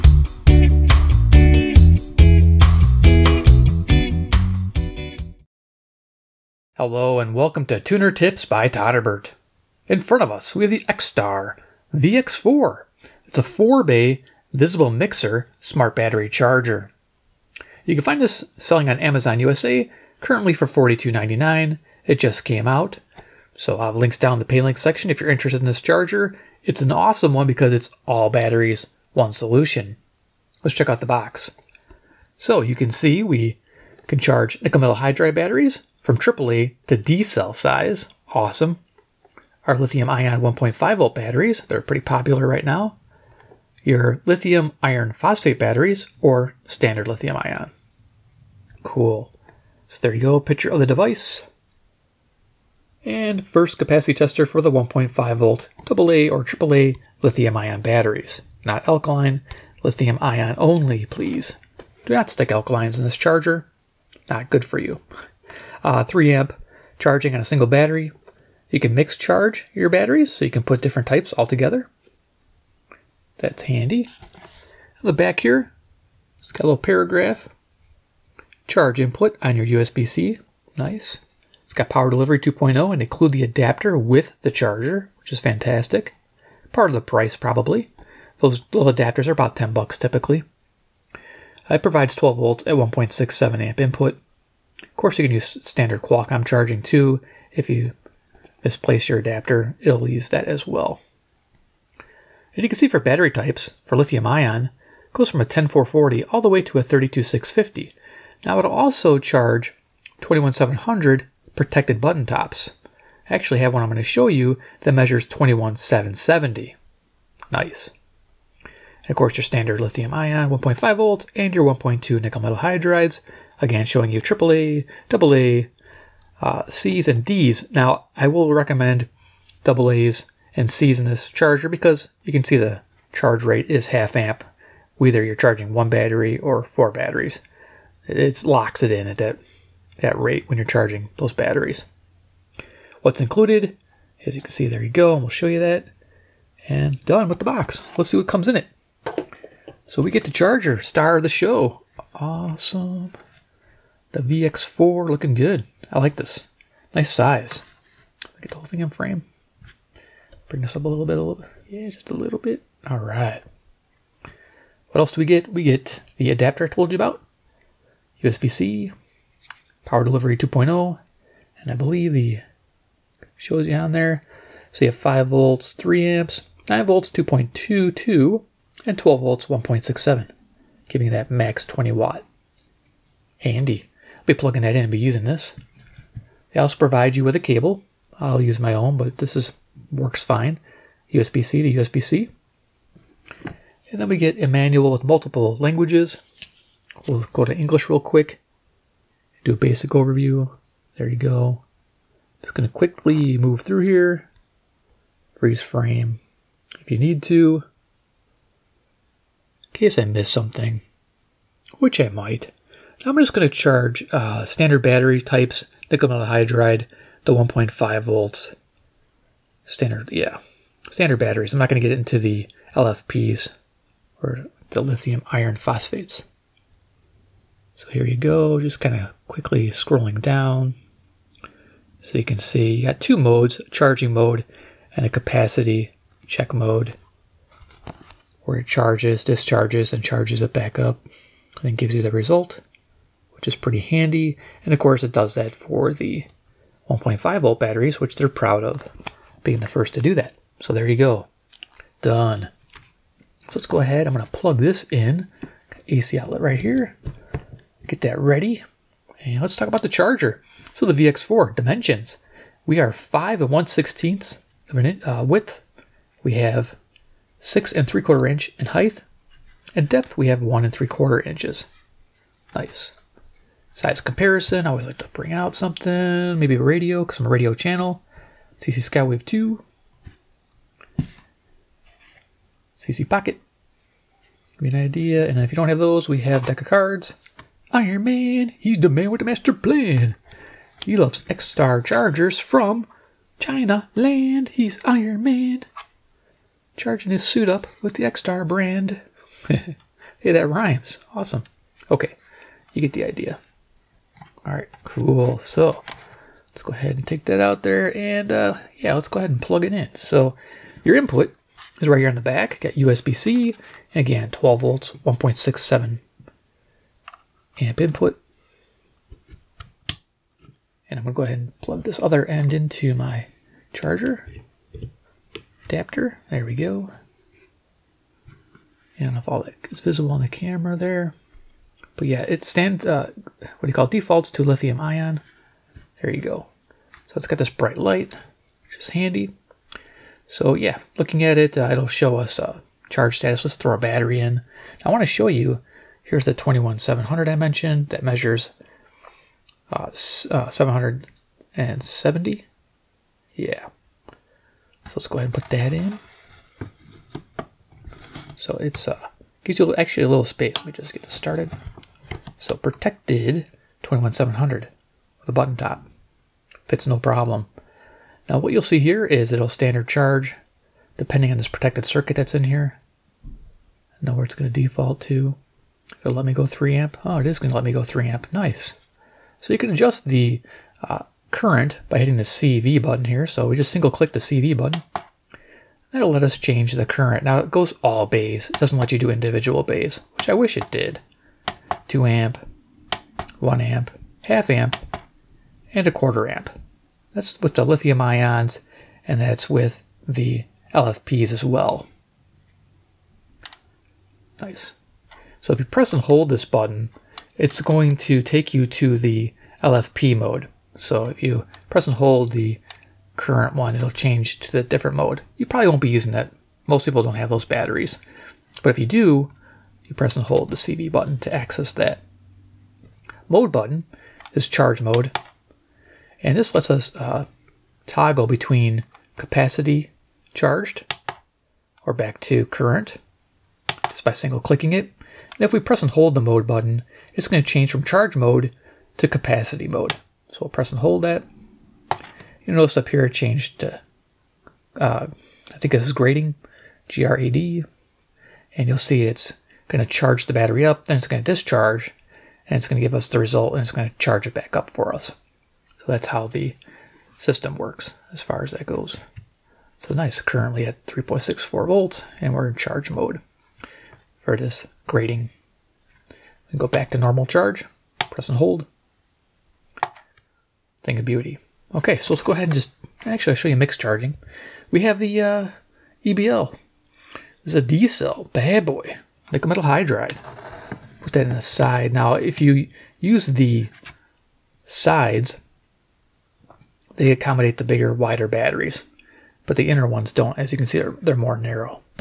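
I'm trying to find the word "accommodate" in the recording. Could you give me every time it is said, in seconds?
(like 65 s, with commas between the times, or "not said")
487 s.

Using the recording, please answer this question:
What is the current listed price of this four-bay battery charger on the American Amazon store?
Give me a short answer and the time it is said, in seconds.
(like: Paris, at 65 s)
$42.99, at 20 s.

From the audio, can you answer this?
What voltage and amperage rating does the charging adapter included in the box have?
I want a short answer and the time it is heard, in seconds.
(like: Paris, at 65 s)
12 volts at 1.67 amp, at 92 s.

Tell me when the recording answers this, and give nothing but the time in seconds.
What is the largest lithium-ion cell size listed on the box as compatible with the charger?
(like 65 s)
106 s.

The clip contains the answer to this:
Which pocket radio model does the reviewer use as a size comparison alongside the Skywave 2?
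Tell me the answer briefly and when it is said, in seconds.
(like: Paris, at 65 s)
CC Pocket, at 282 s.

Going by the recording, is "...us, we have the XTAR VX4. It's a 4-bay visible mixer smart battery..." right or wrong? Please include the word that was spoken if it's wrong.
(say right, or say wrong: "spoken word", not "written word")
right.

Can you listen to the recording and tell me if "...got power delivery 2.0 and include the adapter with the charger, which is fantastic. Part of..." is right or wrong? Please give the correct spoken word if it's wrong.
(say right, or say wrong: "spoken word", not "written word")
right.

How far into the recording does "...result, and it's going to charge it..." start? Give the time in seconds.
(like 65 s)
453 s.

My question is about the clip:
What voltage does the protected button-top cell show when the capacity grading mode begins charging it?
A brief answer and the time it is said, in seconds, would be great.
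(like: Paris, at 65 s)
3.64 volts, at 460 s.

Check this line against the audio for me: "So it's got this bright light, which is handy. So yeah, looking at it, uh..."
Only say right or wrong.
right.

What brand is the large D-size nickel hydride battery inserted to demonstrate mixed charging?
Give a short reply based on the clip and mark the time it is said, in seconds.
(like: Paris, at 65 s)
EBL, at 476 s.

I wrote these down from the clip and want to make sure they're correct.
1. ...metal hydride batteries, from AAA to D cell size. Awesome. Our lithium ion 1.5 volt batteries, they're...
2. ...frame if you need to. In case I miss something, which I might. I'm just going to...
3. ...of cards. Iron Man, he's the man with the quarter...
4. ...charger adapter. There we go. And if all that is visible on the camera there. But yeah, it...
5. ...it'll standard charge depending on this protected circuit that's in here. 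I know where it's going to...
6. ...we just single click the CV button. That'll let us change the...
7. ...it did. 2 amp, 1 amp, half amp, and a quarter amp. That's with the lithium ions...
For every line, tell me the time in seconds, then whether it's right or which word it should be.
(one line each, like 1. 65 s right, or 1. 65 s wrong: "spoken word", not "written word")
1. 34 s right
2. 205 s right
3. 286 s wrong: "master", not "quarter"
4. 323 s right
5. 369 s right
6. 383 s right
7. 390 s right.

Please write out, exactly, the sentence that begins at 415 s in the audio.
You probably won't be using that.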